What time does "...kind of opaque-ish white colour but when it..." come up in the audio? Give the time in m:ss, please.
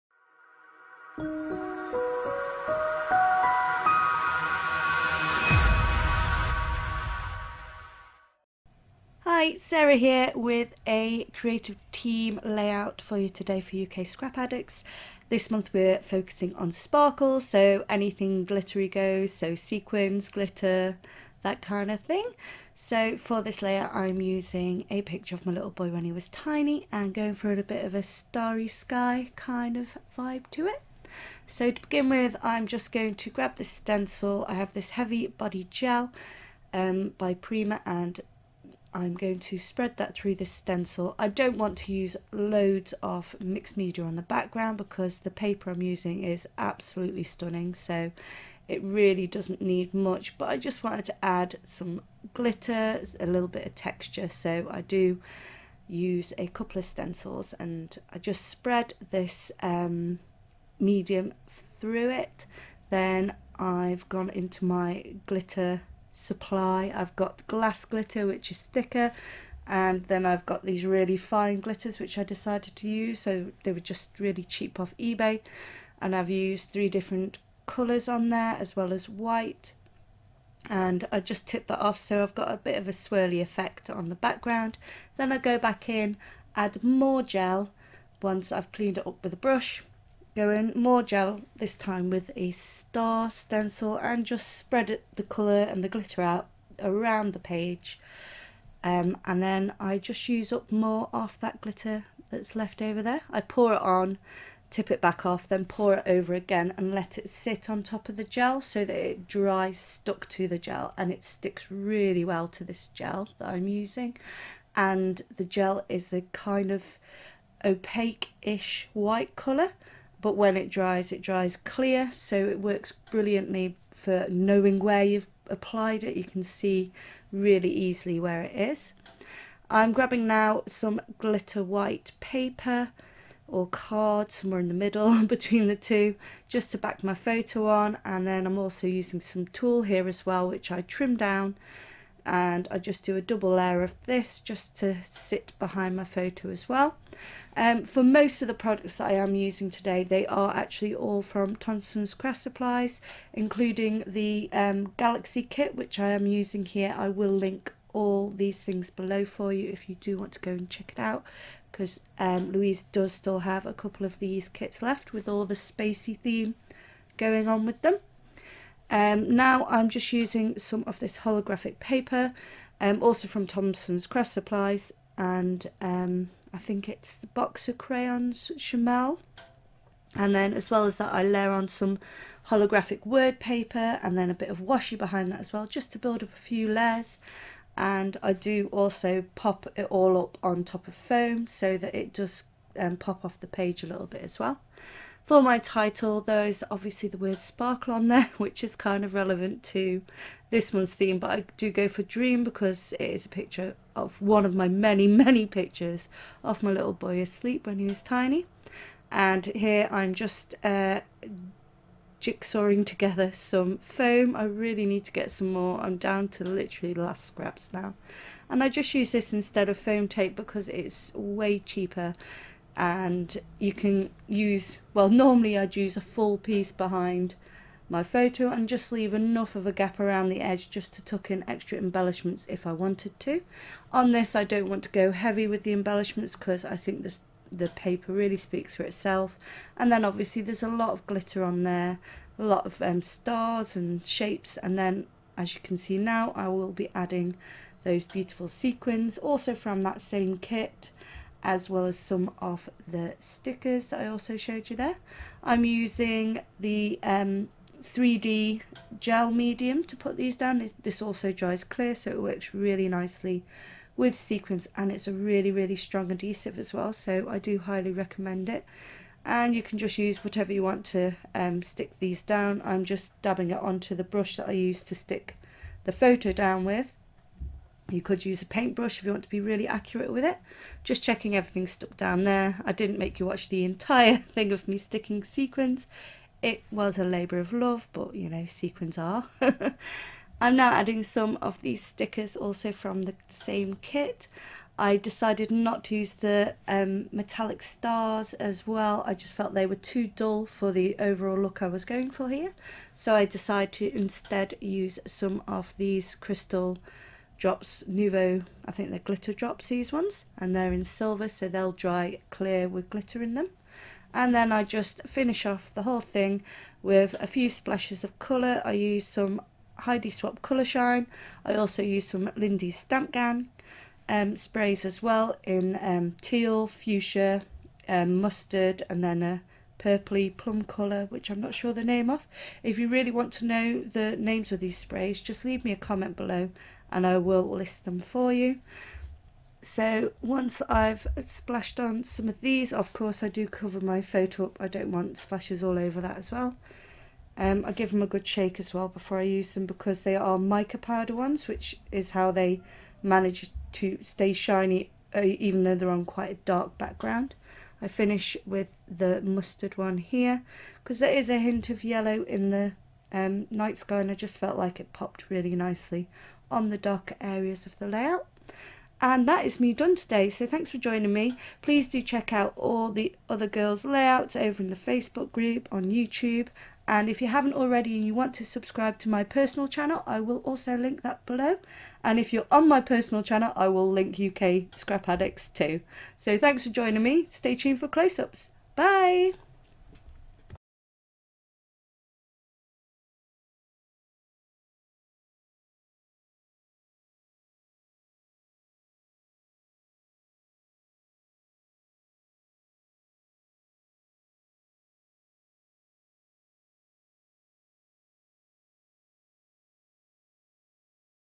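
1:56.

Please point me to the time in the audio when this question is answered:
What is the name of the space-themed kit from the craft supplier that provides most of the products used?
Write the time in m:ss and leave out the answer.
2:34.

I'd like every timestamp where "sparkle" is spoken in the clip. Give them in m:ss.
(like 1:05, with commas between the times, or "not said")
0:16, 3:17.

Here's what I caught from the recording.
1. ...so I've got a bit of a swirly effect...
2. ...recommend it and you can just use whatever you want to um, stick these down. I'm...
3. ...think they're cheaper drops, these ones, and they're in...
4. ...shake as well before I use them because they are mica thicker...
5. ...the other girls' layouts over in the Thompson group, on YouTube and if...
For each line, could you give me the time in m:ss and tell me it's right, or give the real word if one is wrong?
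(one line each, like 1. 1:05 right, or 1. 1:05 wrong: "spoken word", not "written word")
1. 1:21 right
2. 4:27 right
3. 5:08 wrong: "glitter", not "cheaper"
4. 5:48 wrong: "powder", not "thicker"
5. 6:12 wrong: "Facebook", not "Thompson".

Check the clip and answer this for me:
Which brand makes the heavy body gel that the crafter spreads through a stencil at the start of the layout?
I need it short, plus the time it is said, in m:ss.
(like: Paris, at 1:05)
Prima, at 0:37.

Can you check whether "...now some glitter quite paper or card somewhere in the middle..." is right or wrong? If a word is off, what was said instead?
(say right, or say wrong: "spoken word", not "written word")
wrong: "white", not "quite".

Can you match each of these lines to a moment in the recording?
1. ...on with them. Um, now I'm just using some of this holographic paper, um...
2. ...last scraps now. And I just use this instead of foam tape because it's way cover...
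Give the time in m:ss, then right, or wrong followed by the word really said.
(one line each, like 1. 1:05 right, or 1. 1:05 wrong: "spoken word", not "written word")
1. 2:47 right
2. 3:37 wrong: "cheaper", not "cover".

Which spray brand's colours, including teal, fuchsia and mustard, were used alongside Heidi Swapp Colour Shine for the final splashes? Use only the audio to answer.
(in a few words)
Lindy's Stamp Gang.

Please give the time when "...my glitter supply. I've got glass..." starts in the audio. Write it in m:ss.
1:04.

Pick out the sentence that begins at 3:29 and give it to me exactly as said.
And here I'm just uh, jigsawing together some foam.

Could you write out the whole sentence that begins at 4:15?
I'm using the um, 3D gel medium to put these down.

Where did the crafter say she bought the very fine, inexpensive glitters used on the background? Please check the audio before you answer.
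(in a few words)
eBay.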